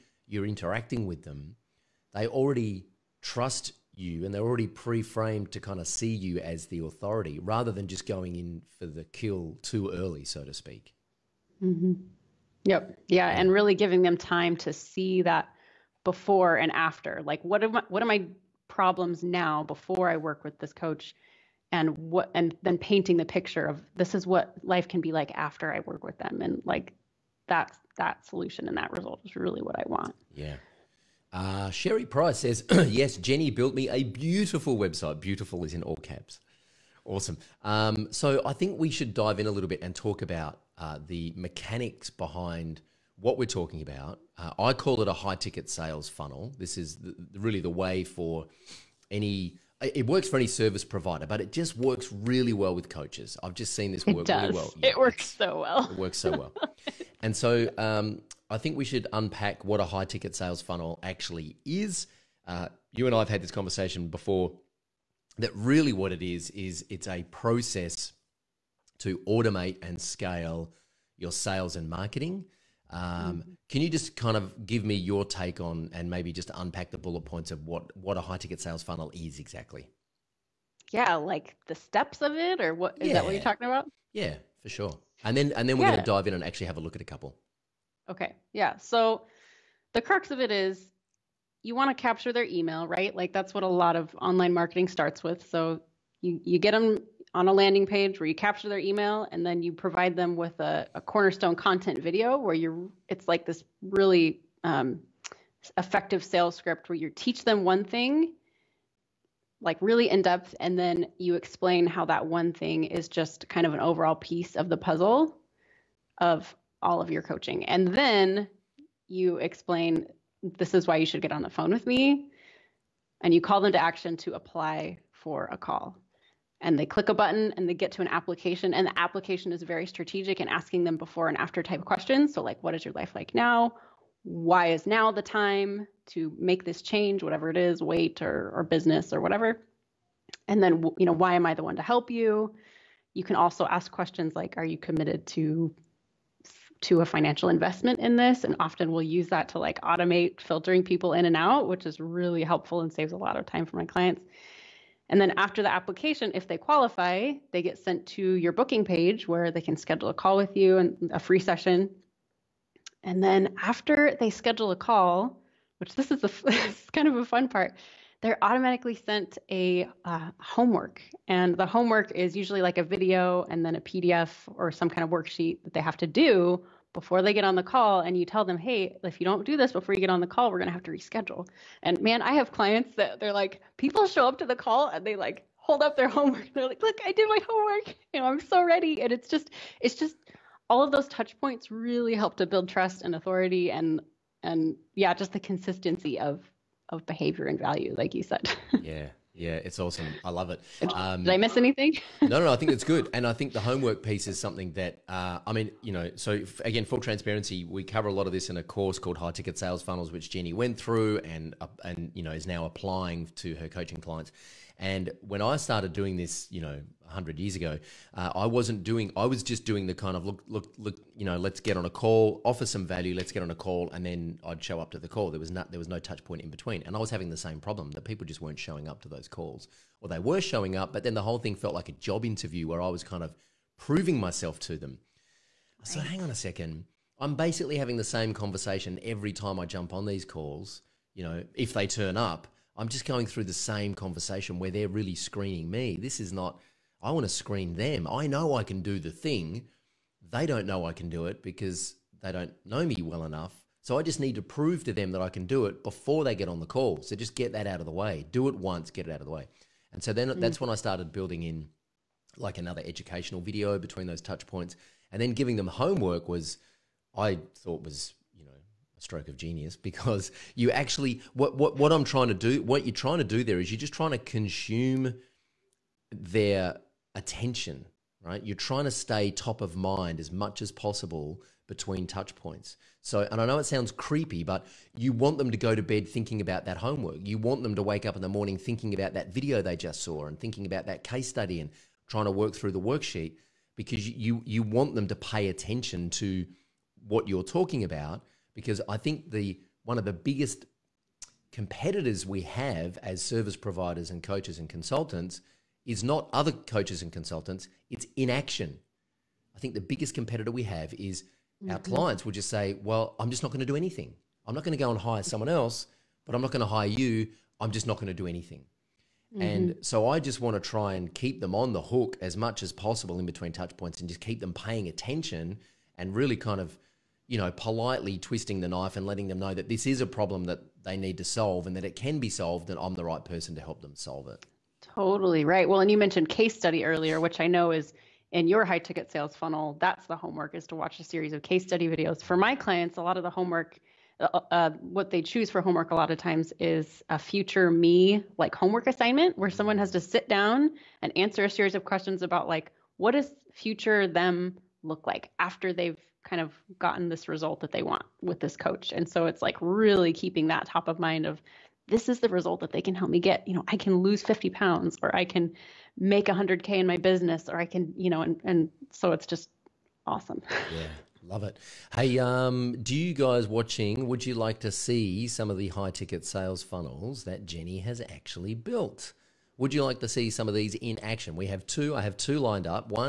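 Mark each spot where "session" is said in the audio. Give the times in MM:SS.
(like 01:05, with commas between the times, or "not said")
02:41.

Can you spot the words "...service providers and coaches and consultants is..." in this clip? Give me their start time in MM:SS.
05:03.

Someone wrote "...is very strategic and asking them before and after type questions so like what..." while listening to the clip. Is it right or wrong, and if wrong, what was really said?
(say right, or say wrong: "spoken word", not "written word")
right.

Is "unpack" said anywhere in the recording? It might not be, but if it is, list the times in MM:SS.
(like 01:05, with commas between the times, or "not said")
00:59, 01:16.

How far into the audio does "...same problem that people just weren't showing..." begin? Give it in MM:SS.
03:47.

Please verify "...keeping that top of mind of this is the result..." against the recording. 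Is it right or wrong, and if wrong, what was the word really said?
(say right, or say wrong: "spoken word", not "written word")
right.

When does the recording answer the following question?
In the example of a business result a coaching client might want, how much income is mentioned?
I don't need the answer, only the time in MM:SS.
06:06.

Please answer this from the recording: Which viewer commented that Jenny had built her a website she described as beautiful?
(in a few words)
Sherry Price.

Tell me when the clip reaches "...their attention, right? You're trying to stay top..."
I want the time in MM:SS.
04:36.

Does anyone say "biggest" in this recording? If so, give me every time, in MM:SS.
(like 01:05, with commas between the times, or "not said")
05:00, 05:09.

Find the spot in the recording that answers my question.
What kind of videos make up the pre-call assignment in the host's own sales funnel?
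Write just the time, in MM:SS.
05:41.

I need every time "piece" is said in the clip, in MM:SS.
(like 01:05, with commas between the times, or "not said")
01:54, 03:24.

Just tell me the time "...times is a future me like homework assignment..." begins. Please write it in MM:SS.
05:46.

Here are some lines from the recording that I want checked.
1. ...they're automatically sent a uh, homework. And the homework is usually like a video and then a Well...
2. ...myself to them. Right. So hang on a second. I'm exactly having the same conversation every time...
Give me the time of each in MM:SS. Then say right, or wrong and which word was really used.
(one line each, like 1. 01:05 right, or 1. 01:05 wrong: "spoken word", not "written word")
1. 02:48 wrong: "PDF", not "Well"
2. 03:54 wrong: "basically", not "exactly".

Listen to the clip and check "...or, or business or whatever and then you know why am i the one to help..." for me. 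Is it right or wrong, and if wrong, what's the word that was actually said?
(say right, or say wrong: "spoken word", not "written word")
right.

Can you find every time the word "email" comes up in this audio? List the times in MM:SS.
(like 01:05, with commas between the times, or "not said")
01:32, 01:38.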